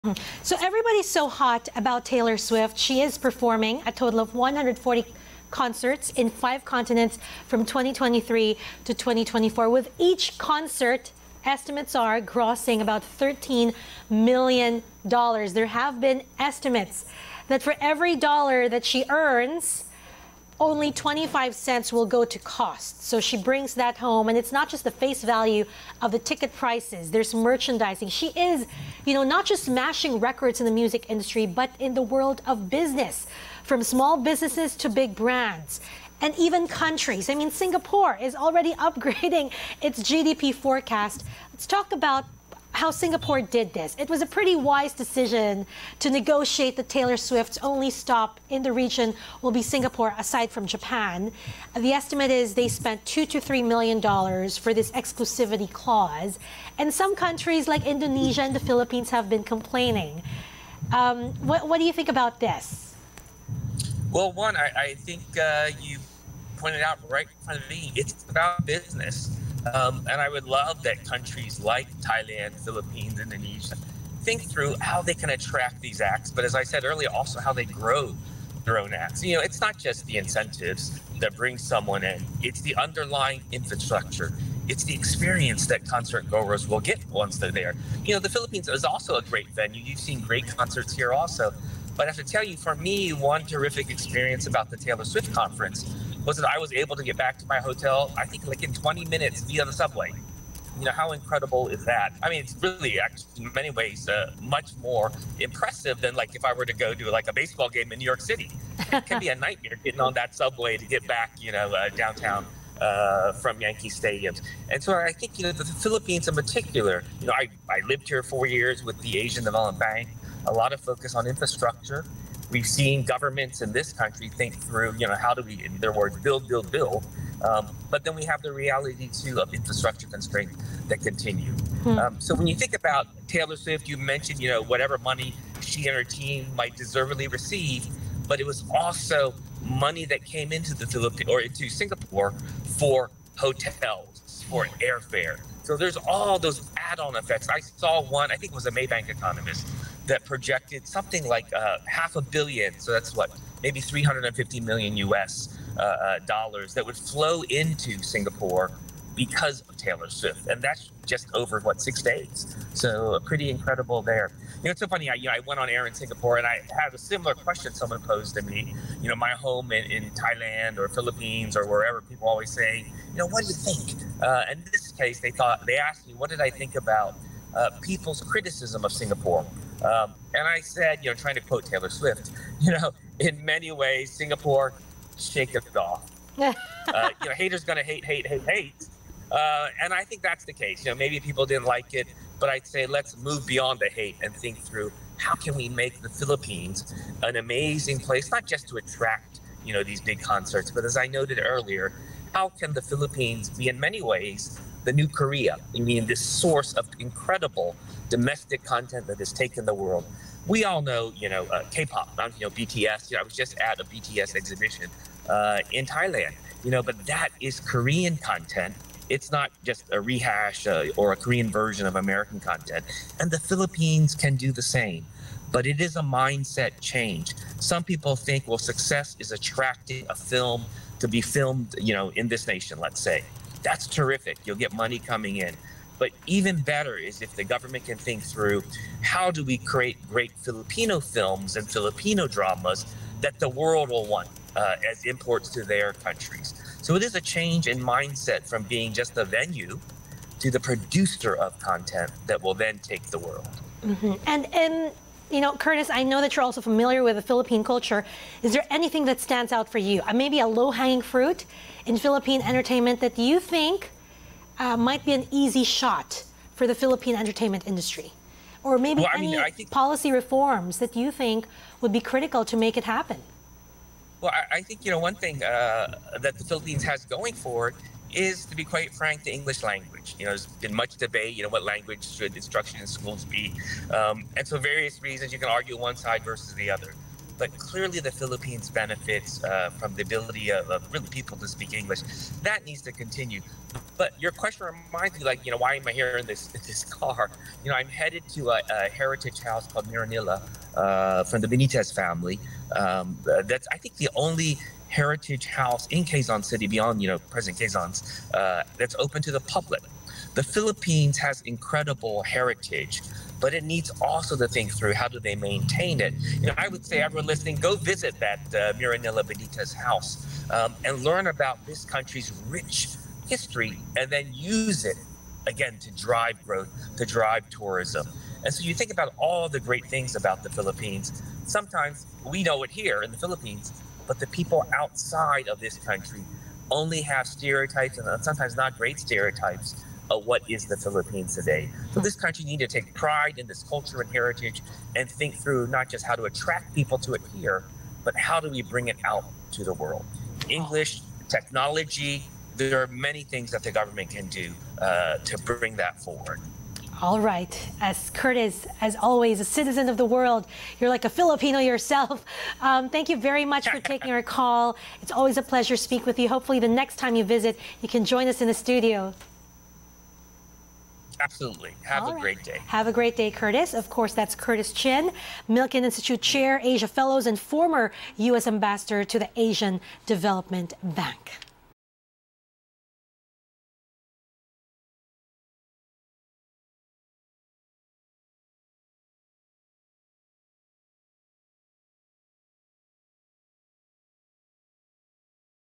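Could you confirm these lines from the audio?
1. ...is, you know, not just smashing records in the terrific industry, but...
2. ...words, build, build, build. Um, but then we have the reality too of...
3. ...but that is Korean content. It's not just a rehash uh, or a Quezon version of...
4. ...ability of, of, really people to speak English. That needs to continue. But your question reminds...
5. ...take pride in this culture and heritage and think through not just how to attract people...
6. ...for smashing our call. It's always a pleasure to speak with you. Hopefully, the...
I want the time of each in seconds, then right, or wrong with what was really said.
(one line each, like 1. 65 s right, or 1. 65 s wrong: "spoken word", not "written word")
1. 28 s wrong: "music", not "terrific"
2. 125 s right
3. 216 s wrong: "Korean", not "Quezon"
4. 290 s right
5. 342 s right
6. 363 s wrong: "taking", not "smashing".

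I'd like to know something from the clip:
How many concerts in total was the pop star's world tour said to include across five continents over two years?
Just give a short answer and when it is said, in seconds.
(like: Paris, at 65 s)
140, at 4 s.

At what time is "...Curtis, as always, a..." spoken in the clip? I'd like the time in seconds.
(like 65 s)
358 s.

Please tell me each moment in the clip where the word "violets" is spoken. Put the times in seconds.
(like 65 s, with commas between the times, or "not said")
not said.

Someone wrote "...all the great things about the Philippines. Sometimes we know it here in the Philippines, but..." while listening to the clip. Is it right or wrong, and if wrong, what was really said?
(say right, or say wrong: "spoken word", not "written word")
right.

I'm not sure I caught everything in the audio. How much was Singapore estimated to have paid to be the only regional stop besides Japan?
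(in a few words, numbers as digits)
two to three million dollars.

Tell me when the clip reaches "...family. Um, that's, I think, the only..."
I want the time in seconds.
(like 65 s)
301 s.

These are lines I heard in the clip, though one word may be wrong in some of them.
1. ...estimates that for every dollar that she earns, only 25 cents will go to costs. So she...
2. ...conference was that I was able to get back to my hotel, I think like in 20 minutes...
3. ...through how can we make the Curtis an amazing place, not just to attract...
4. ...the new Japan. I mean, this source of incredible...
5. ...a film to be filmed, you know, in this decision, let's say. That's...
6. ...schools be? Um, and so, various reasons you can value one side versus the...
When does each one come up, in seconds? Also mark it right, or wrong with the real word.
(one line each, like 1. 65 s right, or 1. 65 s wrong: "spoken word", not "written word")
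1. 16 s right
2. 95 s right
3. 194 s wrong: "Philippines", not "Curtis"
4. 204 s wrong: "Korea", not "Japan"
5. 230 s wrong: "nation", not "decision"
6. 282 s wrong: "argue", not "value".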